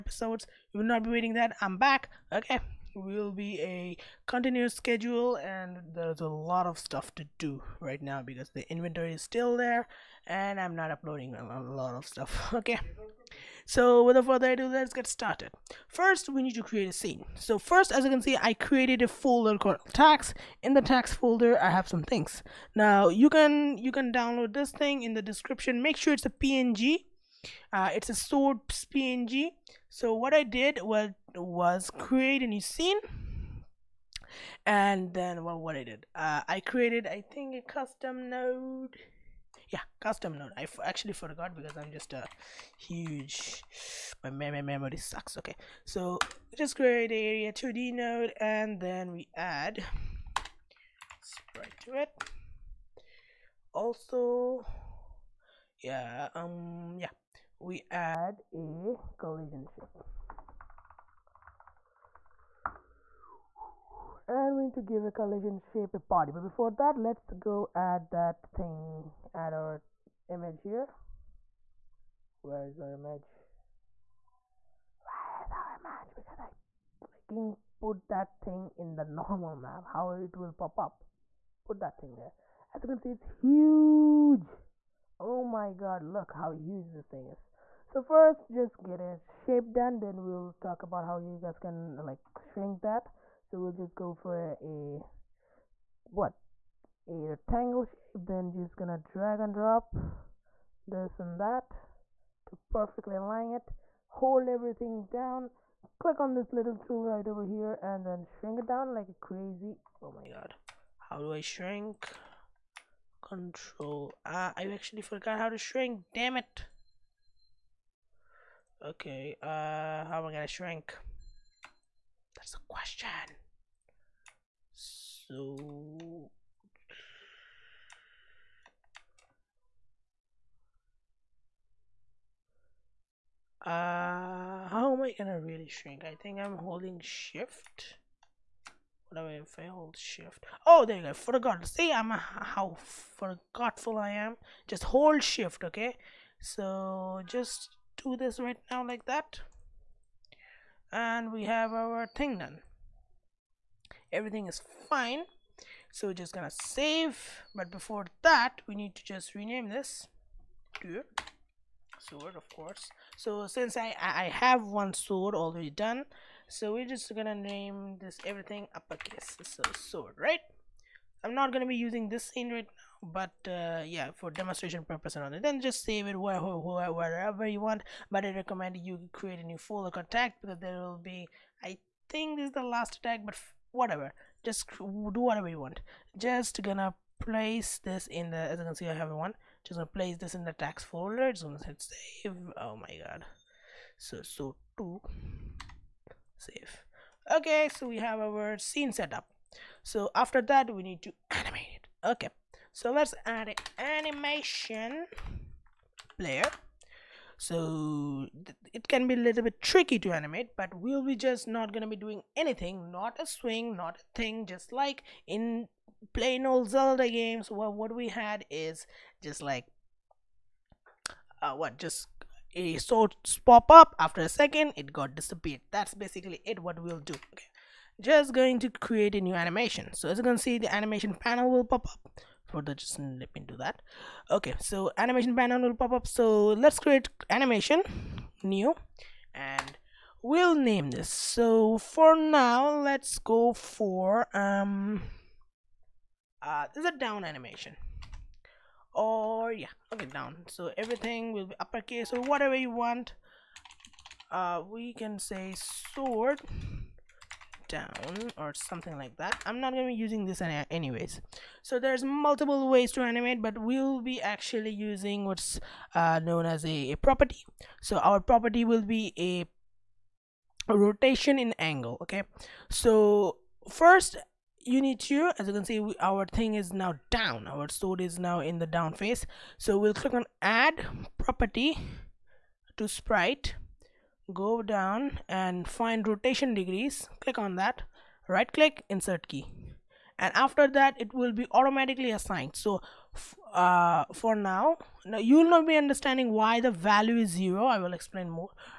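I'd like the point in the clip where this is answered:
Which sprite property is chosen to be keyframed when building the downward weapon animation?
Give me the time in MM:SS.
04:46.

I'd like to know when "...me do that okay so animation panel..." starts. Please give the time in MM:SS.
03:53.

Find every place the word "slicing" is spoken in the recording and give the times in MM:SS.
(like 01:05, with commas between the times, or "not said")
not said.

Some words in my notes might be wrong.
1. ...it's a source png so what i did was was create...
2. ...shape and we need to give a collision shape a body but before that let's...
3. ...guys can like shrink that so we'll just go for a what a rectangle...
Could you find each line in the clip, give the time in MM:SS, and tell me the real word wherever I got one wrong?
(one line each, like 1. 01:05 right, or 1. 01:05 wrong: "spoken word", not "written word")
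1. 00:27 right
2. 00:59 right
3. 01:31 right.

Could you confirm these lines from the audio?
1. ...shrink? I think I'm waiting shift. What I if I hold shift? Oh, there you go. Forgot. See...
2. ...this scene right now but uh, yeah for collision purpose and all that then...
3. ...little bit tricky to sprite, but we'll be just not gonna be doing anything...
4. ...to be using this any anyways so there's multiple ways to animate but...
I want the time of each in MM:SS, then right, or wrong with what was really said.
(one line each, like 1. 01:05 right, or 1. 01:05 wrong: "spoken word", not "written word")
1. 02:15 wrong: "holding", not "waiting"
2. 02:52 wrong: "demonstration", not "collision"
3. 03:29 wrong: "animate", not "sprite"
4. 04:19 right.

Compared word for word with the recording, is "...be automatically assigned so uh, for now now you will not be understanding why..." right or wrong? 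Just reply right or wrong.
right.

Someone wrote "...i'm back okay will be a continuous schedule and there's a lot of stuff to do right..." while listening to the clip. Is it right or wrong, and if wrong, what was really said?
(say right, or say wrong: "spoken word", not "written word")
right.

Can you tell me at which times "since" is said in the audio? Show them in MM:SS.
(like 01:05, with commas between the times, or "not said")
02:43.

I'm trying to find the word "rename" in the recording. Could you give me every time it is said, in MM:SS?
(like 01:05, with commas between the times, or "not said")
02:39.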